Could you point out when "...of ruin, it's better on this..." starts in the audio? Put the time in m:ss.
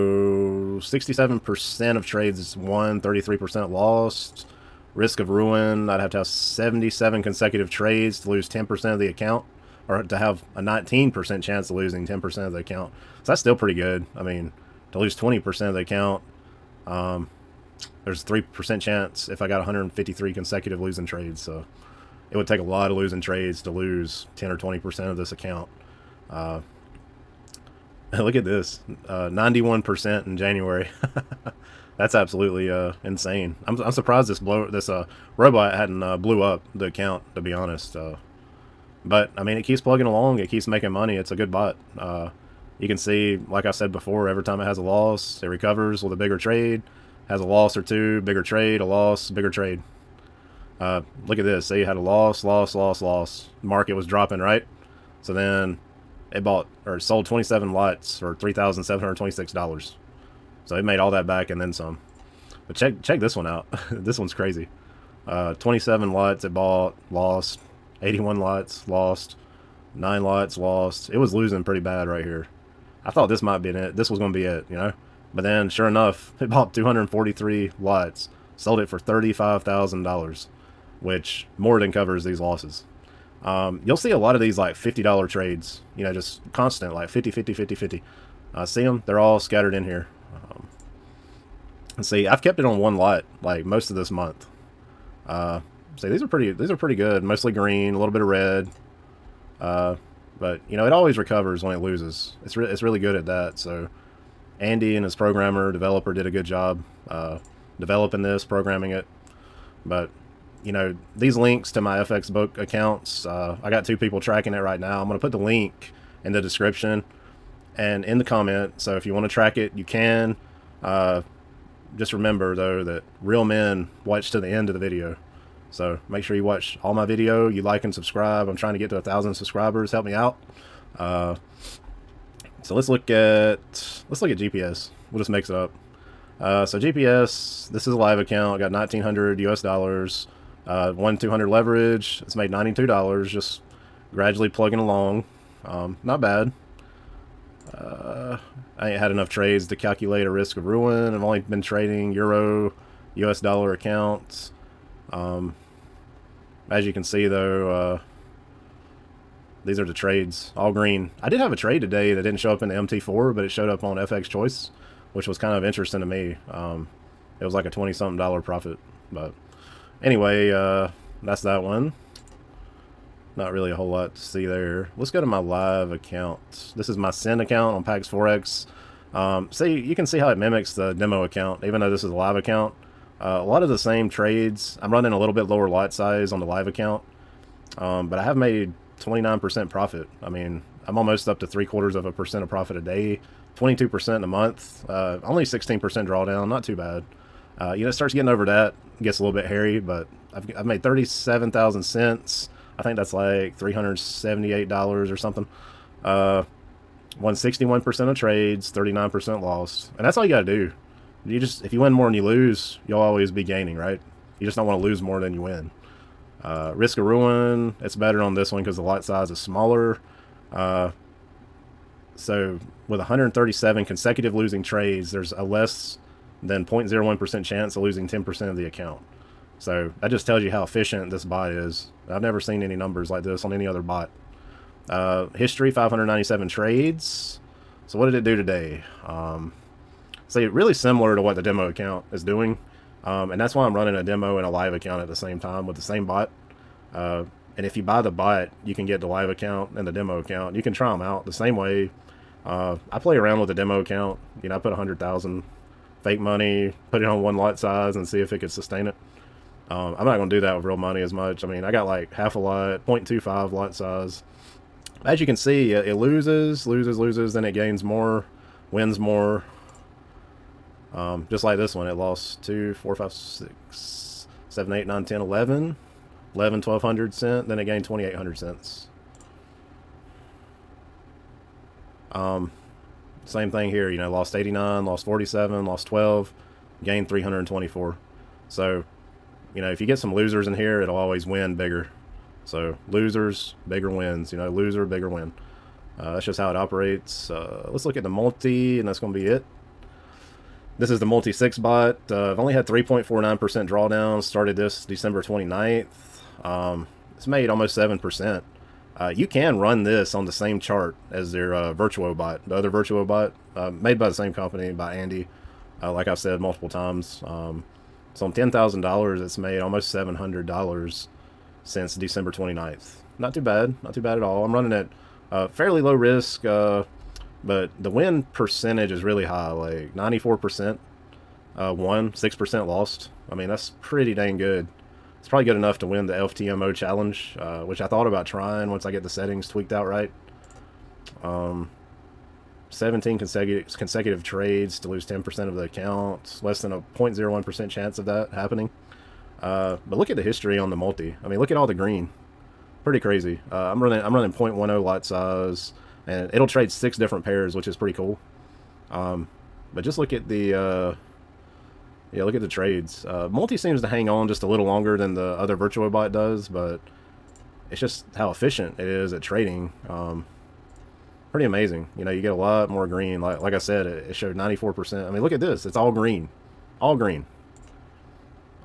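3:36.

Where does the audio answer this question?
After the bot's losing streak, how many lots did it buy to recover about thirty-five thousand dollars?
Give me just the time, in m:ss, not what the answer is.
1:16.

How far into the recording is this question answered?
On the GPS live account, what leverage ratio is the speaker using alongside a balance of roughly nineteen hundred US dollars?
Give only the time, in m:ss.
2:20.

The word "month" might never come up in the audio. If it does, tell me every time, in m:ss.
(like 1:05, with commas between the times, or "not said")
1:34, 3:14.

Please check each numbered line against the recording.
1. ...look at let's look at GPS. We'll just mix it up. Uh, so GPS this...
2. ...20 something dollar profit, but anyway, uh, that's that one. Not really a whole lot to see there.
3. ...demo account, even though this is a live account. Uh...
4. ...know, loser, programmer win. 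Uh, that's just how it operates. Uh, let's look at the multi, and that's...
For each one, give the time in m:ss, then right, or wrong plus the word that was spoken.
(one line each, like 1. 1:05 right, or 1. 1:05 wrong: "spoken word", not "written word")
1. 2:12 right
2. 2:47 right
3. 3:00 right
4. 4:54 wrong: "bigger", not "programmer".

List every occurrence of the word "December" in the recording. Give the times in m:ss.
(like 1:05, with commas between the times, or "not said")
5:04, 5:21.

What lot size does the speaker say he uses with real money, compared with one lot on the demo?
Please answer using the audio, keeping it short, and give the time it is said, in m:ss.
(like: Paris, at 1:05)
0.25, at 4:22.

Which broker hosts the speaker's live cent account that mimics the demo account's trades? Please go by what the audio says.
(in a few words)
Pax Forex.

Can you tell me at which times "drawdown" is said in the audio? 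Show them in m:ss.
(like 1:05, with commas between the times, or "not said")
3:15, 5:03.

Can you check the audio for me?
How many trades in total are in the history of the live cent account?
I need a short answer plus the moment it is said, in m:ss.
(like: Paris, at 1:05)
597, at 3:55.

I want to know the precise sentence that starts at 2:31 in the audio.
I've only been trading euro, US dollar accounts.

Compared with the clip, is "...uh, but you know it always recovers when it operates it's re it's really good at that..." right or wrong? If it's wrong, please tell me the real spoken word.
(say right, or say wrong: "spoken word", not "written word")
wrong: "loses", not "operates".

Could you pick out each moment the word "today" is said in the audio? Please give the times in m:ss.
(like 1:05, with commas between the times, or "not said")
2:41, 3:58.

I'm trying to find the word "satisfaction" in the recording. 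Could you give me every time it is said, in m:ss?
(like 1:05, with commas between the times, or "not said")
not said.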